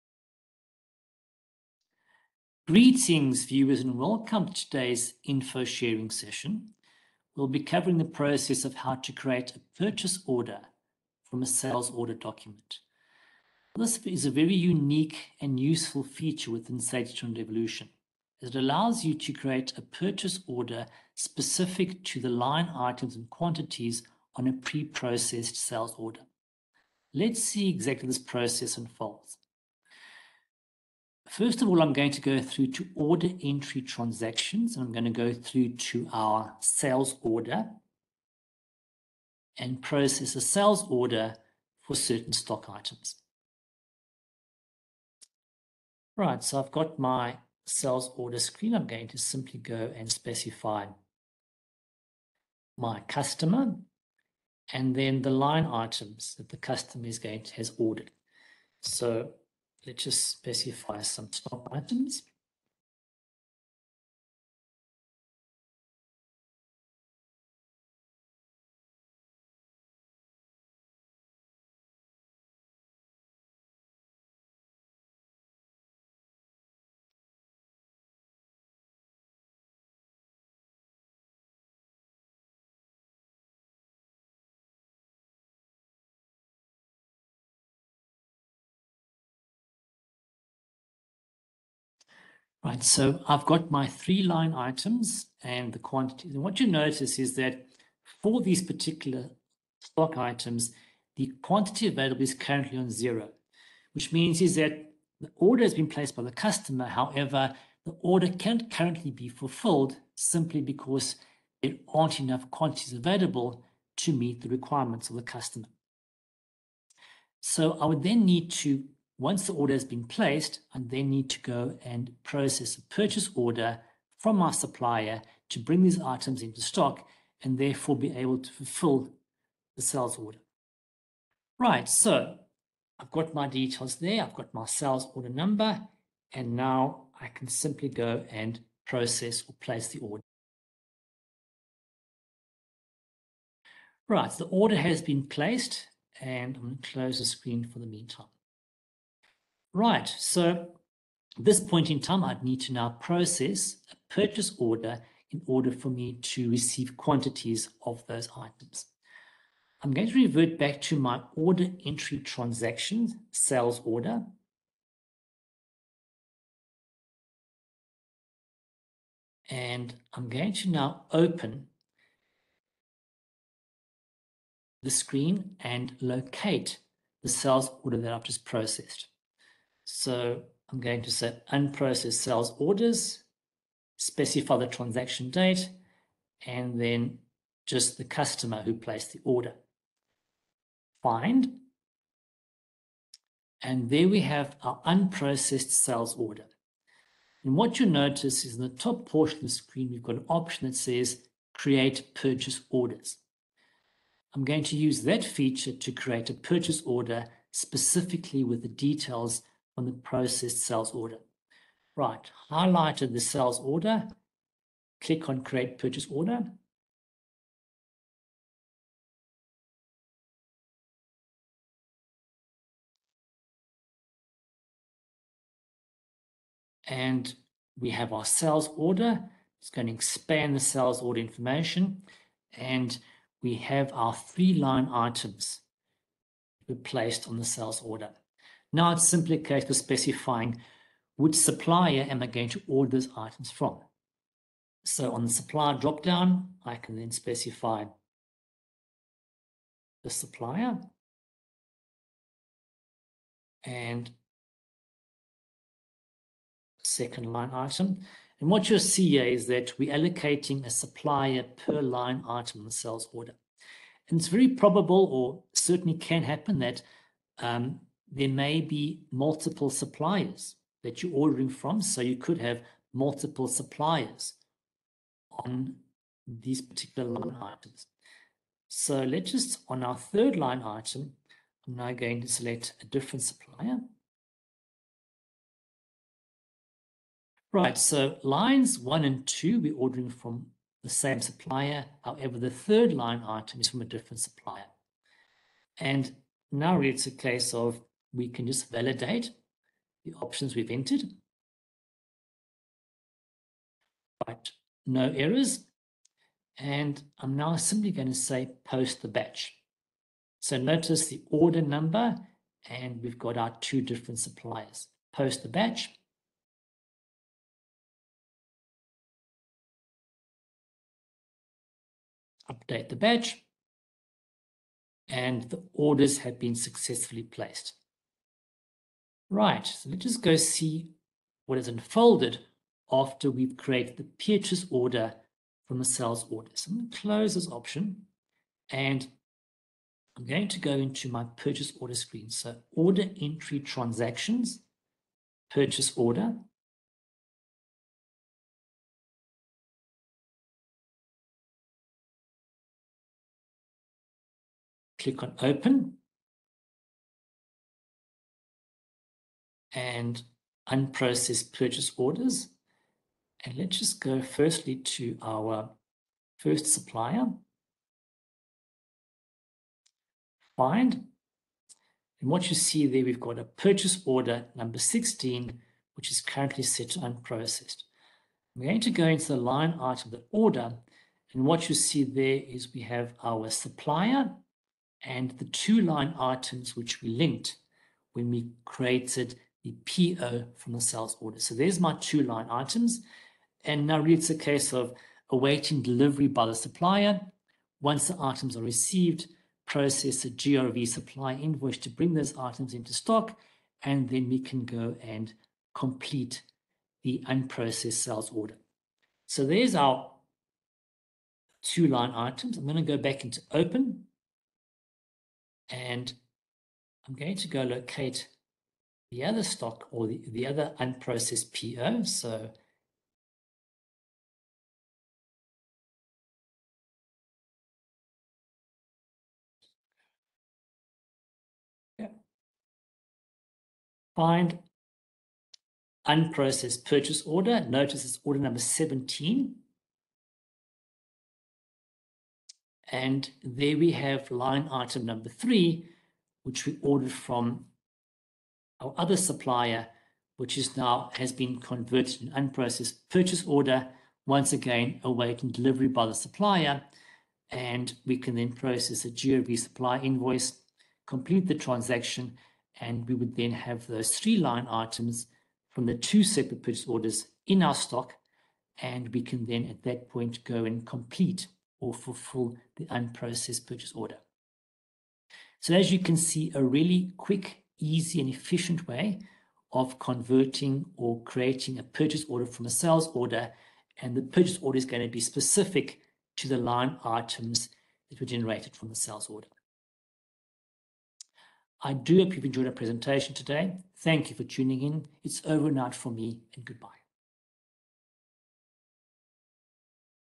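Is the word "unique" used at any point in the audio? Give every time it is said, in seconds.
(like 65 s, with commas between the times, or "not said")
14 s.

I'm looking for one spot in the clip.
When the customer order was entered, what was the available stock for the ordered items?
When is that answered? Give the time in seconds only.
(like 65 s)
102 s.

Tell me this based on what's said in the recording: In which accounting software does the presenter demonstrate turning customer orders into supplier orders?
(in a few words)
SageTrend Evolution.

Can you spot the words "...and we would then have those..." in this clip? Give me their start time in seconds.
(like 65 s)
462 s.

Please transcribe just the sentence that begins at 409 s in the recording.
So there's our two line items.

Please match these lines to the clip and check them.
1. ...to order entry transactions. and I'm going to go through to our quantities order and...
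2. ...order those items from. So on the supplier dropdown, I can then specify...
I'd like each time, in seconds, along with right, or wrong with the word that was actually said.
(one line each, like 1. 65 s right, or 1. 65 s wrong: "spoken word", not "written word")
1. 32 s wrong: "sales", not "quantities"
2. 242 s right.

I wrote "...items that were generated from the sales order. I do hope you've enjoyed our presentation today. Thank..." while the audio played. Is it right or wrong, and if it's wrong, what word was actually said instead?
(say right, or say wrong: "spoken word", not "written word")
right.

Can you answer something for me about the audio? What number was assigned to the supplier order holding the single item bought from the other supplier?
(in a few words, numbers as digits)
17.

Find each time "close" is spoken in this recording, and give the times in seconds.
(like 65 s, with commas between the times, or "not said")
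146 s, 336 s.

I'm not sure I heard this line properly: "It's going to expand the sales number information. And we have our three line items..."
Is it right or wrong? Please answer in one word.
wrong.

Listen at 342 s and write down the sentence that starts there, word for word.
So order entry transactions, purchase order.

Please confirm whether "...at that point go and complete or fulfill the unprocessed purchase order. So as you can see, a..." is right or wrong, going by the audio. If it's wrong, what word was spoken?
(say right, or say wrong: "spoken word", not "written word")
right.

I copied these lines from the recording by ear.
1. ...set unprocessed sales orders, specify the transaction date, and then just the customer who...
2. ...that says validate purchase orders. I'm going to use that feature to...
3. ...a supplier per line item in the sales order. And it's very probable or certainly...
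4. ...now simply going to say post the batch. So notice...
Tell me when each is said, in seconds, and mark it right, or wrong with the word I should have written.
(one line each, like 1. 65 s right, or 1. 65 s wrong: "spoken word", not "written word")
1. 181 s right
2. 200 s wrong: "create", not "validate"
3. 260 s right
4. 307 s right.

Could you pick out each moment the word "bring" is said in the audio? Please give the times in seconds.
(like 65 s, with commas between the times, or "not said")
125 s, 401 s.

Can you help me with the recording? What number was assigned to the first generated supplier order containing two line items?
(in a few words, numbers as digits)
16.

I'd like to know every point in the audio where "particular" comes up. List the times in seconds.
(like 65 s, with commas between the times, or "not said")
98 s, 276 s.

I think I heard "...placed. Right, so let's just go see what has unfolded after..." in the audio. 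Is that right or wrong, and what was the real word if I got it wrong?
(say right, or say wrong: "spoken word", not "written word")
right.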